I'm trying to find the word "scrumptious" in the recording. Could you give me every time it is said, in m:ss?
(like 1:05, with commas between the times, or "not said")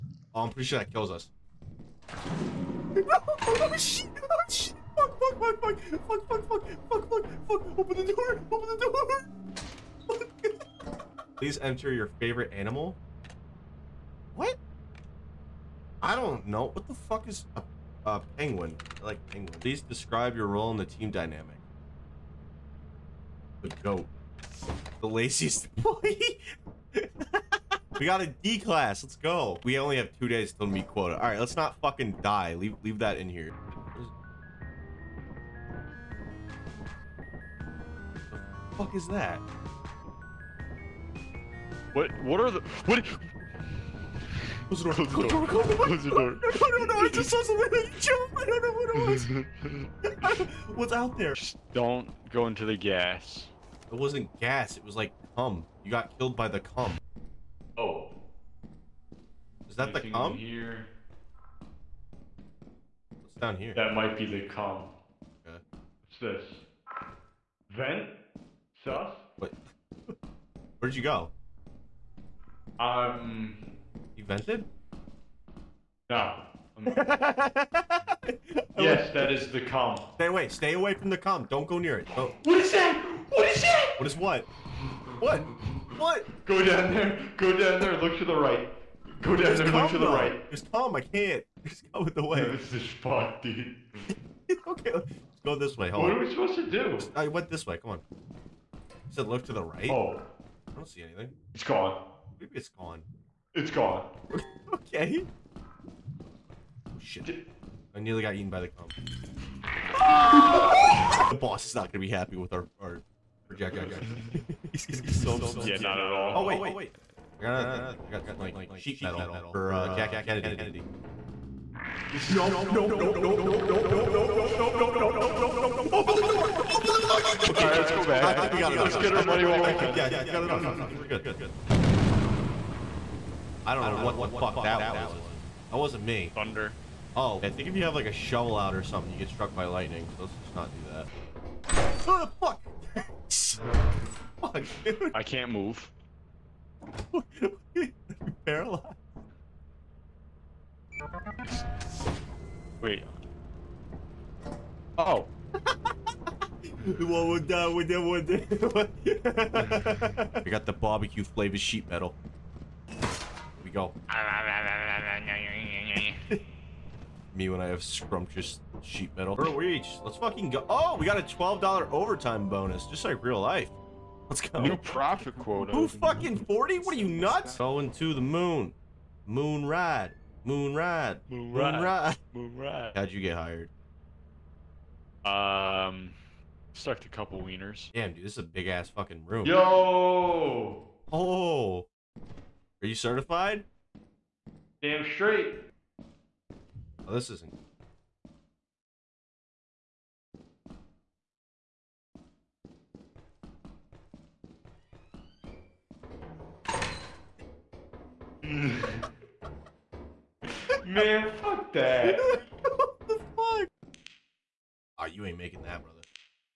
2:47.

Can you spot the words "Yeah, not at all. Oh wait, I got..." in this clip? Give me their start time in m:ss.
1:55.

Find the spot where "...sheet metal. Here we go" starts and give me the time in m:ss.
2:41.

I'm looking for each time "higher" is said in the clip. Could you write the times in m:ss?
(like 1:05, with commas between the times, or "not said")
not said.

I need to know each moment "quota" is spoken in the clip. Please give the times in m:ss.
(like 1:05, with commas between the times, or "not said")
0:30, 2:55.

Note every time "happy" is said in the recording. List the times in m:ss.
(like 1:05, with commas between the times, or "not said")
1:52.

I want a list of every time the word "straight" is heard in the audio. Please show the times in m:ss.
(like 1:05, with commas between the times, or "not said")
3:15.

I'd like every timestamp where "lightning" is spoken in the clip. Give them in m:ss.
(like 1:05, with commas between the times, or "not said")
2:19.